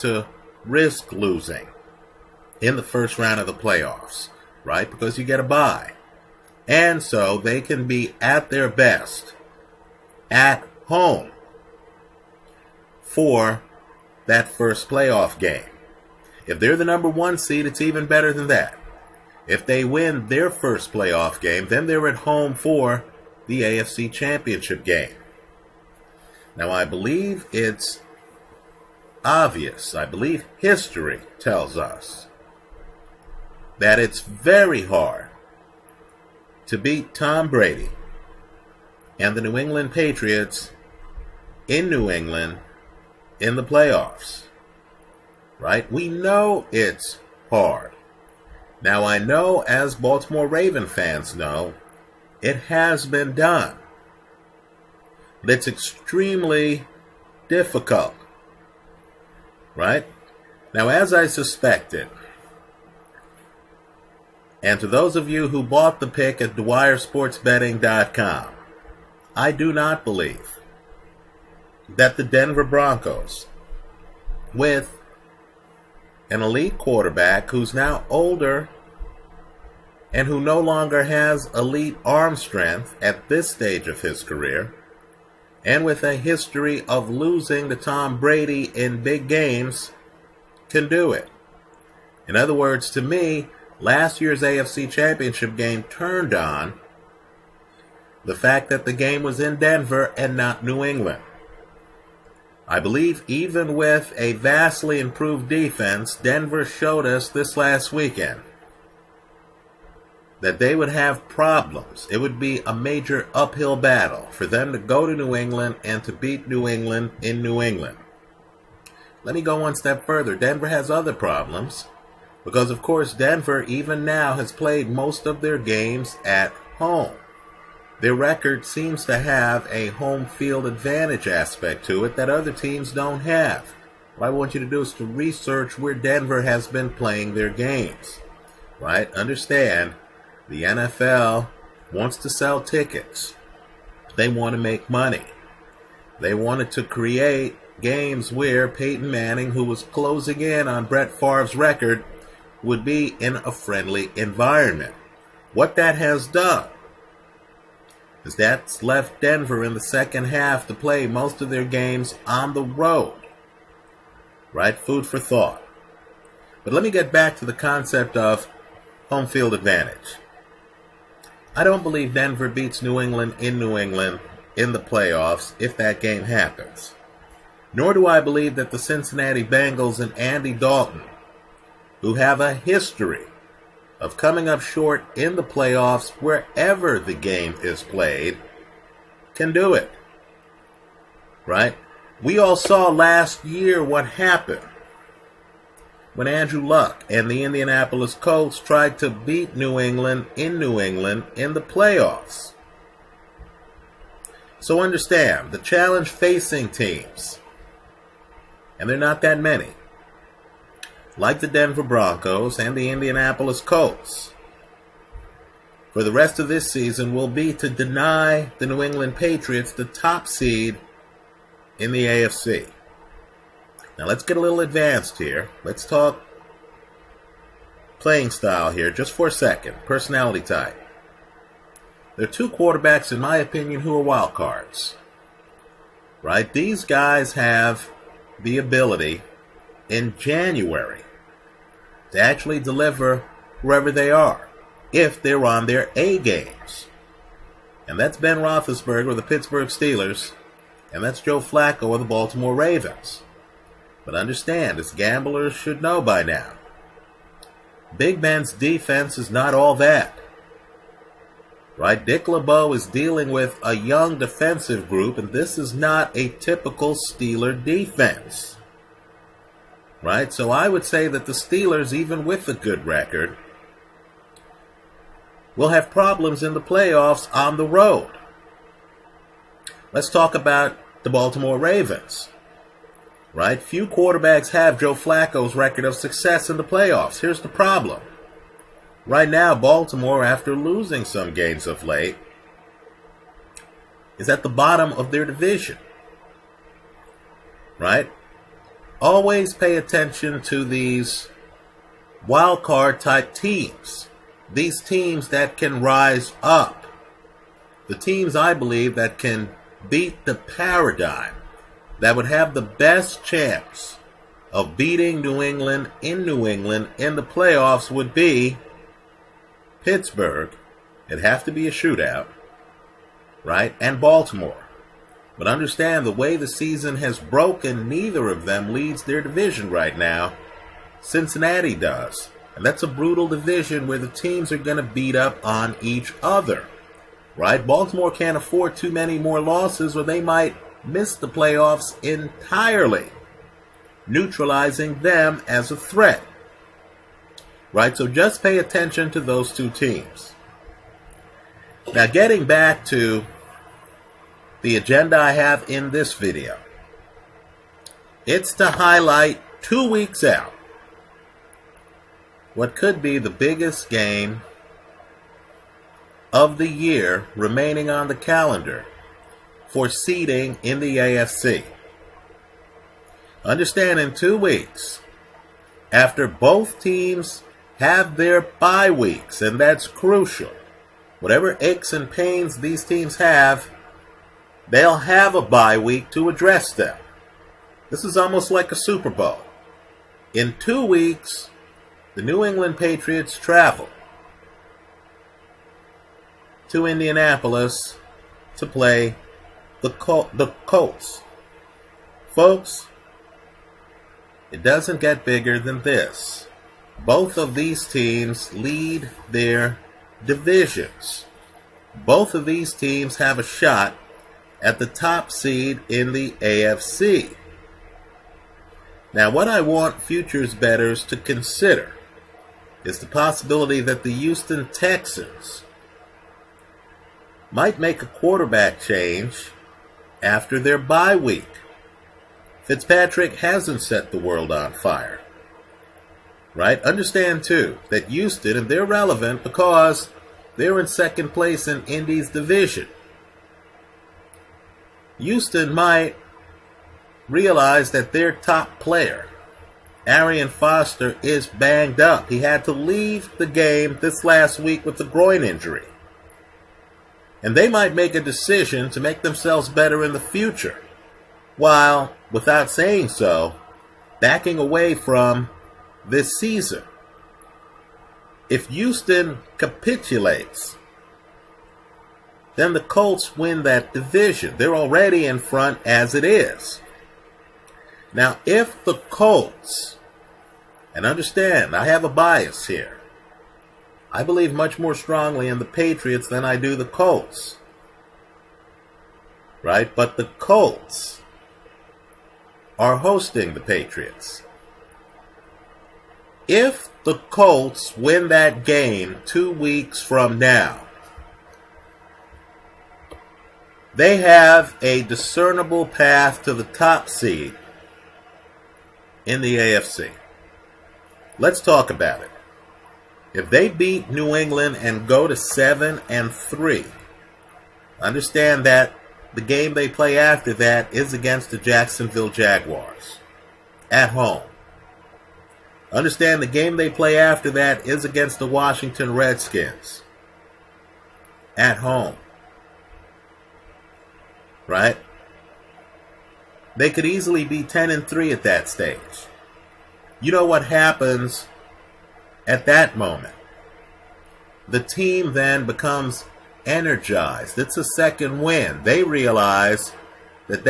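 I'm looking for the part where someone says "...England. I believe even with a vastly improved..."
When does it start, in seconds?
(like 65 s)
100 s.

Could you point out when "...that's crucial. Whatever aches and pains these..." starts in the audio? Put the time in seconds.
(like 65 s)
379 s.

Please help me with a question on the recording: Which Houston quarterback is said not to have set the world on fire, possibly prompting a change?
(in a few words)
Fitzpatrick.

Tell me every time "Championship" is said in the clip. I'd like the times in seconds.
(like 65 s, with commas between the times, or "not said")
24 s, 94 s.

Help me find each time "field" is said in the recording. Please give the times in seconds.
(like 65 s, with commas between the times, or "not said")
130 s, 169 s.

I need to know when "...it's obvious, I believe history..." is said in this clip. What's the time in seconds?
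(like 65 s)
27 s.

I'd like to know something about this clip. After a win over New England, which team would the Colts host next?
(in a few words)
Jacksonville Jaguars.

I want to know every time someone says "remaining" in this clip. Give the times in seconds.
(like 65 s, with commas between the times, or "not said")
367 s.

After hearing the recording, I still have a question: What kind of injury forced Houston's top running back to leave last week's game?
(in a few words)
groin injury.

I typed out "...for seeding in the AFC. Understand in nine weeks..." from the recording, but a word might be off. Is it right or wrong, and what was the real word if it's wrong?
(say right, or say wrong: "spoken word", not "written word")
wrong: "two", not "nine".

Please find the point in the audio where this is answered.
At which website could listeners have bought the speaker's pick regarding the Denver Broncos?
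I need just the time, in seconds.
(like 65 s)
66 s.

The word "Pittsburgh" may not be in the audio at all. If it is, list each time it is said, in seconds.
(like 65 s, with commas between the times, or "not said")
249 s, 319 s.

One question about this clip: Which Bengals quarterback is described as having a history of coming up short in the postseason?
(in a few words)
Andy Dalton.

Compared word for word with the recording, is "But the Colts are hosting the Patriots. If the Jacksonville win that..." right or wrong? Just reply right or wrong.
wrong.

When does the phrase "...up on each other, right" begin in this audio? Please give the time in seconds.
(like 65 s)
335 s.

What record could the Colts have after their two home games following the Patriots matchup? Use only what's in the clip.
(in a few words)
10 and 3.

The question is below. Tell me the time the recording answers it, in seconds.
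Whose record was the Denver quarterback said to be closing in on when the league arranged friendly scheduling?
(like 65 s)
150 s.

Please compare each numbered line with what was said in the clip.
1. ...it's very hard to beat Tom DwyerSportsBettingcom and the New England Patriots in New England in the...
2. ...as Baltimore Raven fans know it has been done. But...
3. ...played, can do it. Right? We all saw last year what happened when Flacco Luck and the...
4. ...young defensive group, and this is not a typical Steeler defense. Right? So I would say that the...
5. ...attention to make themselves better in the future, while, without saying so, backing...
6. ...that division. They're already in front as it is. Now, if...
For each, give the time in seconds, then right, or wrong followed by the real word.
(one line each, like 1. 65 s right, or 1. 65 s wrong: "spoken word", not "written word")
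1. 33 s wrong: "Brady", not "DwyerSportsBettingcom"
2. 49 s right
3. 187 s wrong: "Andrew", not "Flacco"
4. 263 s right
5. 458 s wrong: "decision", not "attention"
6. 473 s right.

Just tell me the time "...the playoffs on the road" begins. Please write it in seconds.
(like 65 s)
276 s.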